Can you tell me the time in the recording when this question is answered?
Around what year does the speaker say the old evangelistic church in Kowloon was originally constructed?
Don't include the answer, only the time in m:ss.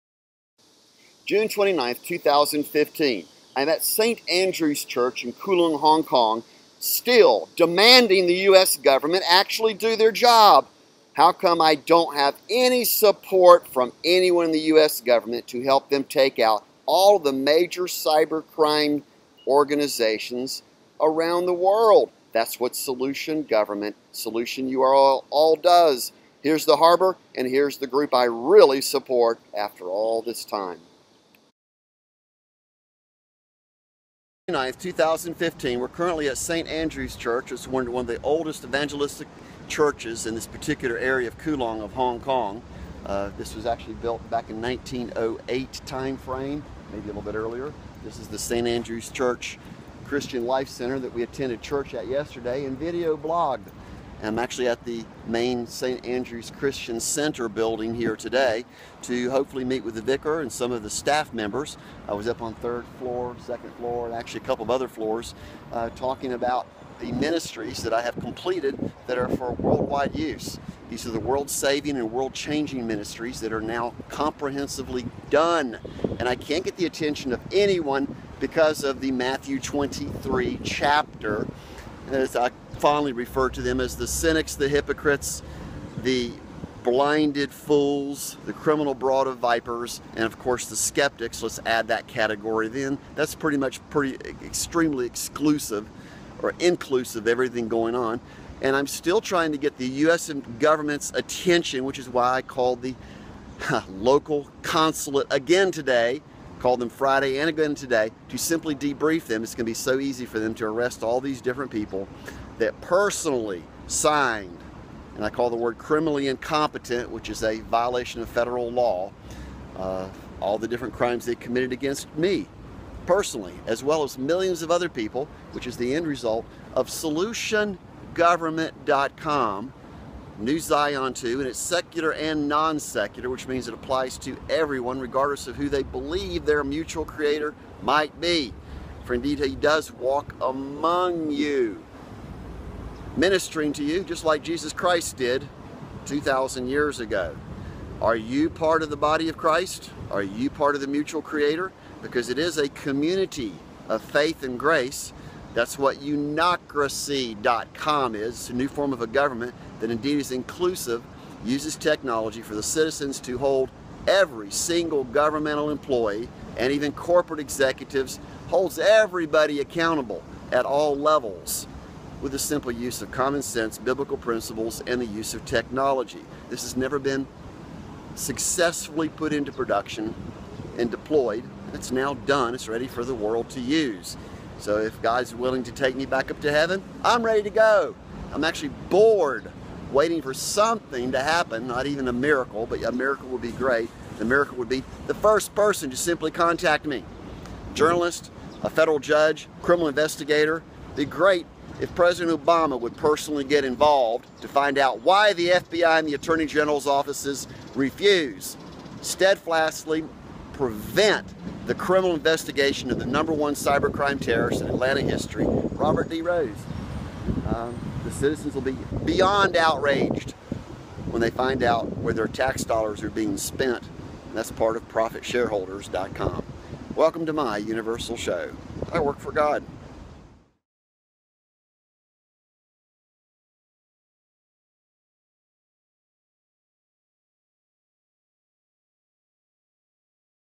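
0:44.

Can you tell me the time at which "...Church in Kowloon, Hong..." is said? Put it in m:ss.
0:04.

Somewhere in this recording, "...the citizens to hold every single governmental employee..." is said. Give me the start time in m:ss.
2:42.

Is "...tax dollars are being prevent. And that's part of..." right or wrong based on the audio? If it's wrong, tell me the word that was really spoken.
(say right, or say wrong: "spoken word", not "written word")
wrong: "spent", not "prevent".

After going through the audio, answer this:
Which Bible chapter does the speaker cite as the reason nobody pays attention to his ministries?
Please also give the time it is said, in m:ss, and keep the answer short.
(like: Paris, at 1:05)
Matthew 23, at 1:19.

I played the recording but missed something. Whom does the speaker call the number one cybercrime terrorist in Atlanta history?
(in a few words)
Robert D. 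Rose.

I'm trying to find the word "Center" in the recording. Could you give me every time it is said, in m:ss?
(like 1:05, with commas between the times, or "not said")
0:50, 0:56.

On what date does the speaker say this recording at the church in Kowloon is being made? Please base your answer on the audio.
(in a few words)
June 29th.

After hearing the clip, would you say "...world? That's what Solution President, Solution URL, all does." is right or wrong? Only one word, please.
wrong.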